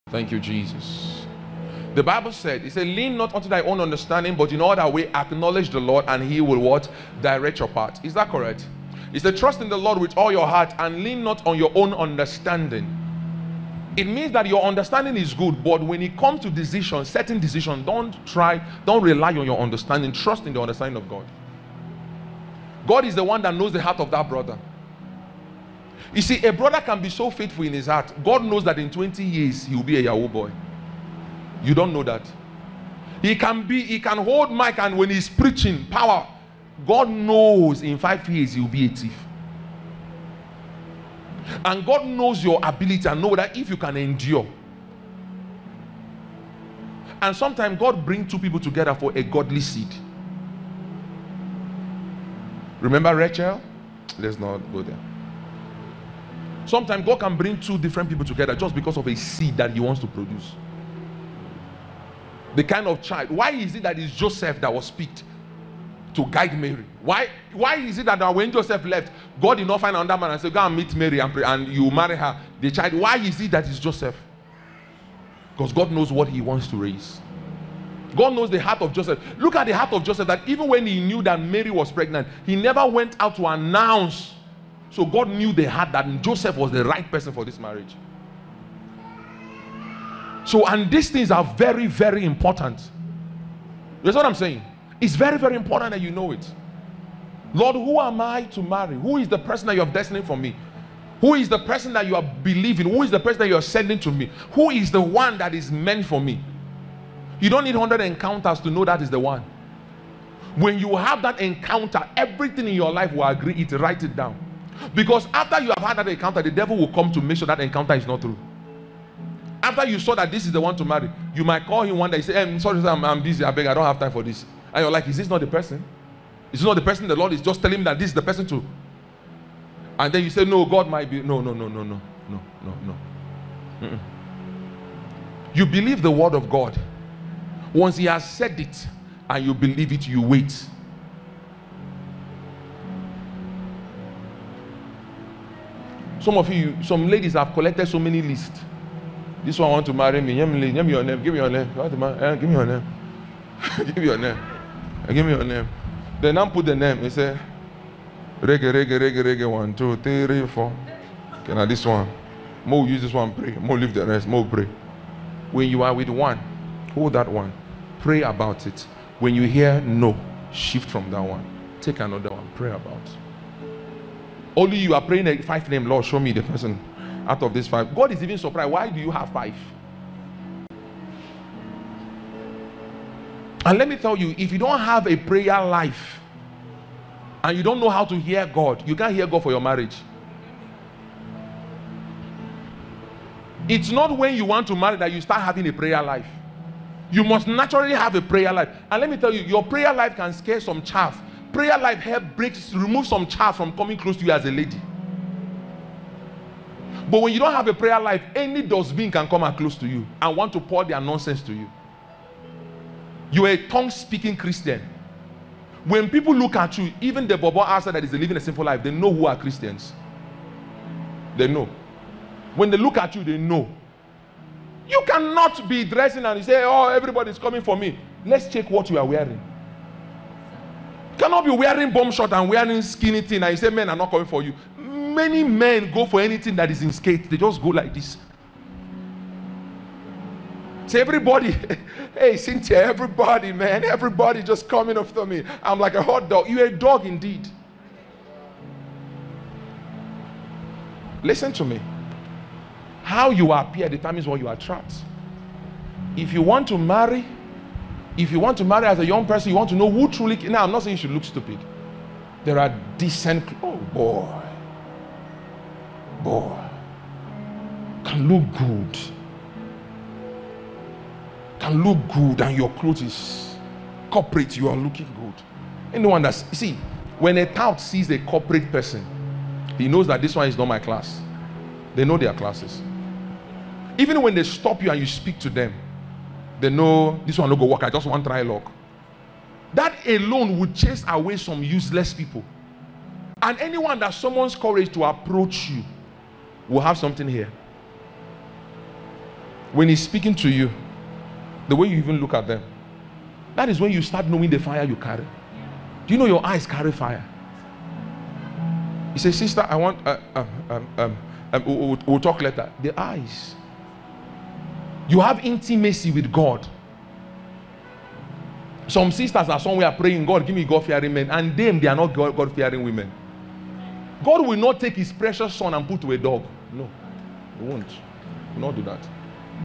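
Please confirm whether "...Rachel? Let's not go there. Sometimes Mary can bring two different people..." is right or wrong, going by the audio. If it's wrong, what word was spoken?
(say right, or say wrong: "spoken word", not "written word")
wrong: "God", not "Mary".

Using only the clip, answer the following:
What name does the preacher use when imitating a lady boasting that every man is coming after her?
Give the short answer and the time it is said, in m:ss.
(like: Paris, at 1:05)
Cynthia, at 4:02.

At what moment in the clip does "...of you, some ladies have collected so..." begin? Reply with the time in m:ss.
2:26.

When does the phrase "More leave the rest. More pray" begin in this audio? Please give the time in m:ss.
2:43.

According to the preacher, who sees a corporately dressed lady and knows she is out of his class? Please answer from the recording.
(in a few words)
A tout.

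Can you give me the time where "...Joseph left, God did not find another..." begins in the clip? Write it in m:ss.
1:08.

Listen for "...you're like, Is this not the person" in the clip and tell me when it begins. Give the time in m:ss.
2:04.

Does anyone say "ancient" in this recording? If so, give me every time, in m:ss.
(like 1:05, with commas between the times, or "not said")
not said.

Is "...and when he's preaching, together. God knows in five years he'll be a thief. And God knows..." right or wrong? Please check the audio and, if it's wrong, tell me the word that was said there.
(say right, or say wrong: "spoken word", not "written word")
wrong: "power", not "together".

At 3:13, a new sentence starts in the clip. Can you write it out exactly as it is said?
It's not when you want to marry that you start having a prayer life.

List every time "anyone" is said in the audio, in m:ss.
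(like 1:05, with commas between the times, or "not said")
4:35, 4:53.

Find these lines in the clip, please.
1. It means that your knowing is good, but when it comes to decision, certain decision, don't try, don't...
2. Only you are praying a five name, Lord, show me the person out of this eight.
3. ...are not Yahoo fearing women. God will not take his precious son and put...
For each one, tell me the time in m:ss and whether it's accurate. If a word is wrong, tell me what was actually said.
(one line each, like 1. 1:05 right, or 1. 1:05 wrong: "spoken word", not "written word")
1. 0:13 wrong: "understanding", not "knowing"
2. 2:54 wrong: "five", not "eight"
3. 5:21 wrong: "God", not "Yahoo".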